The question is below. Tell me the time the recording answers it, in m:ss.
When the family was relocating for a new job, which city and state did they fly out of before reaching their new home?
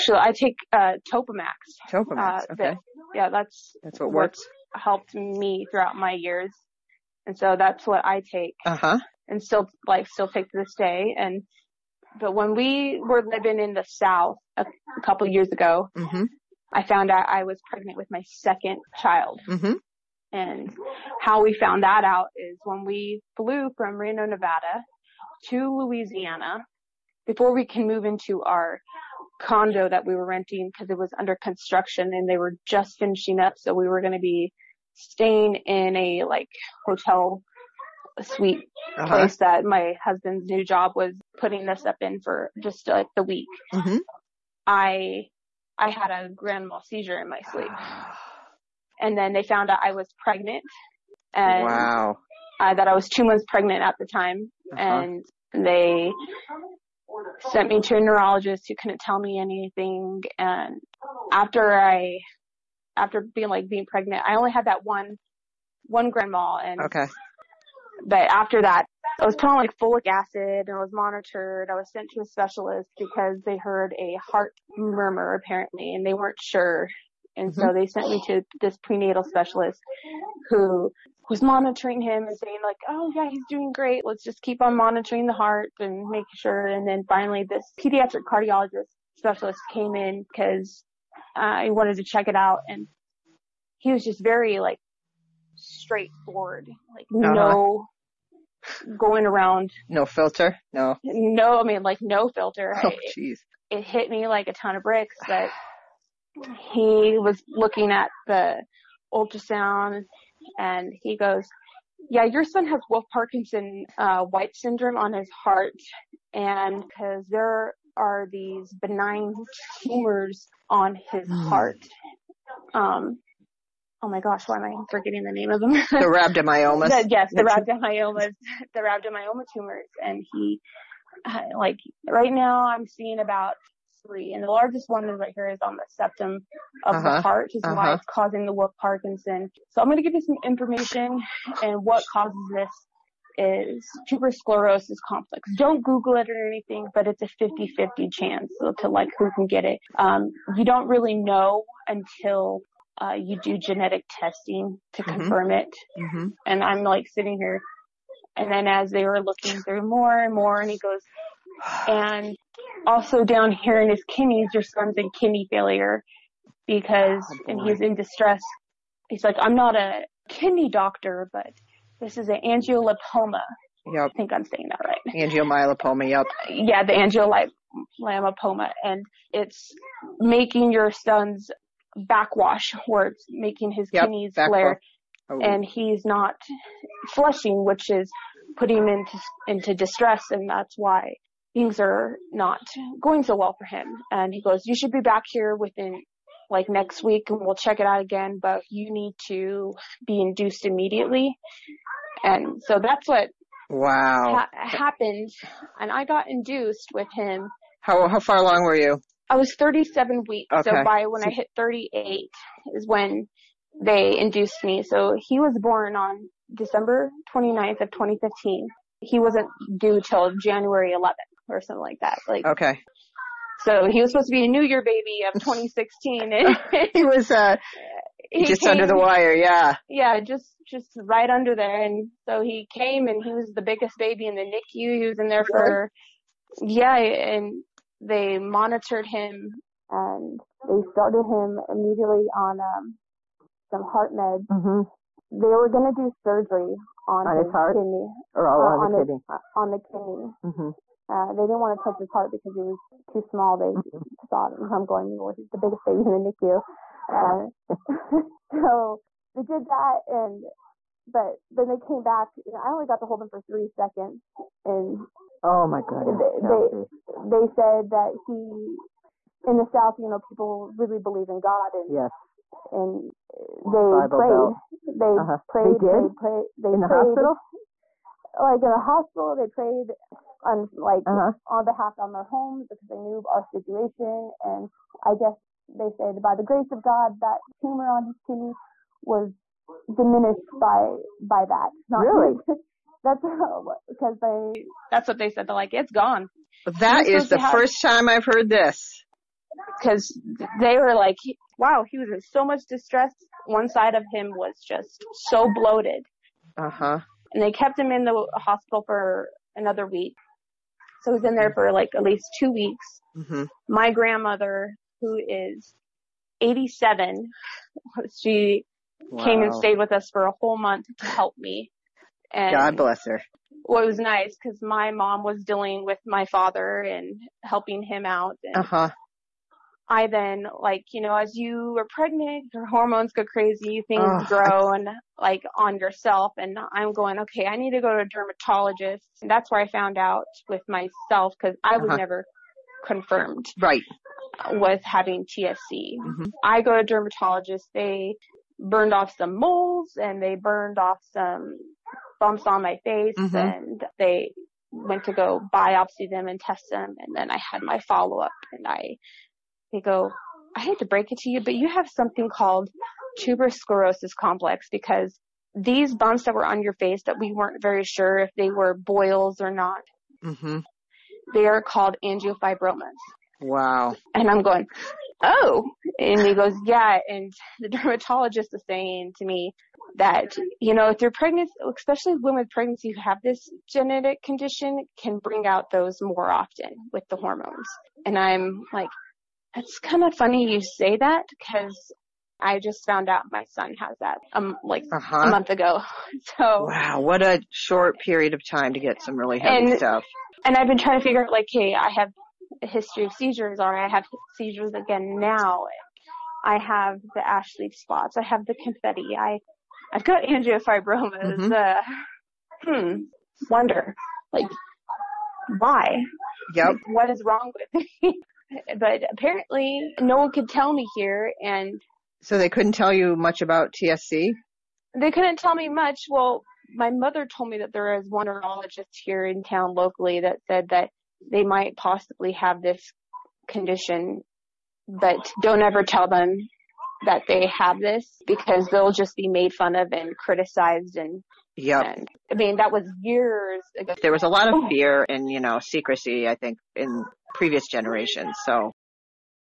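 0:23.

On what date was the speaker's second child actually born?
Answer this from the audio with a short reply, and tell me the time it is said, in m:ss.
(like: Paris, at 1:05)
December 29, 2015, at 3:36.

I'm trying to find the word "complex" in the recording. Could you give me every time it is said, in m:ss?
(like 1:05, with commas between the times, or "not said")
2:25, 6:04.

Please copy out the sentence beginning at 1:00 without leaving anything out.
And after I, after being like being pregnant, I only had that one, one grand mal.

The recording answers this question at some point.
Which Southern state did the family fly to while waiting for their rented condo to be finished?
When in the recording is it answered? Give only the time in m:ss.
0:25.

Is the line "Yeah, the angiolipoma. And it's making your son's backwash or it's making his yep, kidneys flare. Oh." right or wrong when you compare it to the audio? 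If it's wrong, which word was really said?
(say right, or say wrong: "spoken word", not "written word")
right.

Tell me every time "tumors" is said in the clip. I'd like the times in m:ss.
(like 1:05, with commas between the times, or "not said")
1:59, 2:09, 4:47.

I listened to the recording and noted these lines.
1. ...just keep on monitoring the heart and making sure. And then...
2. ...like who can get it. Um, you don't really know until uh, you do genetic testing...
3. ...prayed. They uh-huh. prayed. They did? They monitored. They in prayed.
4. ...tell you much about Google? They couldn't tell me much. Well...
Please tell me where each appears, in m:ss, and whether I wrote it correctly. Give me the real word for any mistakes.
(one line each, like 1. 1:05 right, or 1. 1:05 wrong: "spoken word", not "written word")
1. 1:24 right
2. 2:28 right
3. 4:34 wrong: "prayed", not "monitored"
4. 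7:02 wrong: "TSC", not "Google".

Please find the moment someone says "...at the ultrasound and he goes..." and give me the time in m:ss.
1:47.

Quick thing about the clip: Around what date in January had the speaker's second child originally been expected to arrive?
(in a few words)
January 11.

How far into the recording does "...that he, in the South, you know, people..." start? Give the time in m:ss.
4:27.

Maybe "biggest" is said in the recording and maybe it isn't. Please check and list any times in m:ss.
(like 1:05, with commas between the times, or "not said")
3:53, 4:15.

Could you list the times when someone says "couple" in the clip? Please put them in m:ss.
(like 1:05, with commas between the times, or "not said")
0:15.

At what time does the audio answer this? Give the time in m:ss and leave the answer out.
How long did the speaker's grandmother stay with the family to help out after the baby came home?
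5:20.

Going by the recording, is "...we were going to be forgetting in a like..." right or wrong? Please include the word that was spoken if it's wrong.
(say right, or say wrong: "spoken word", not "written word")
wrong: "staying", not "forgetting".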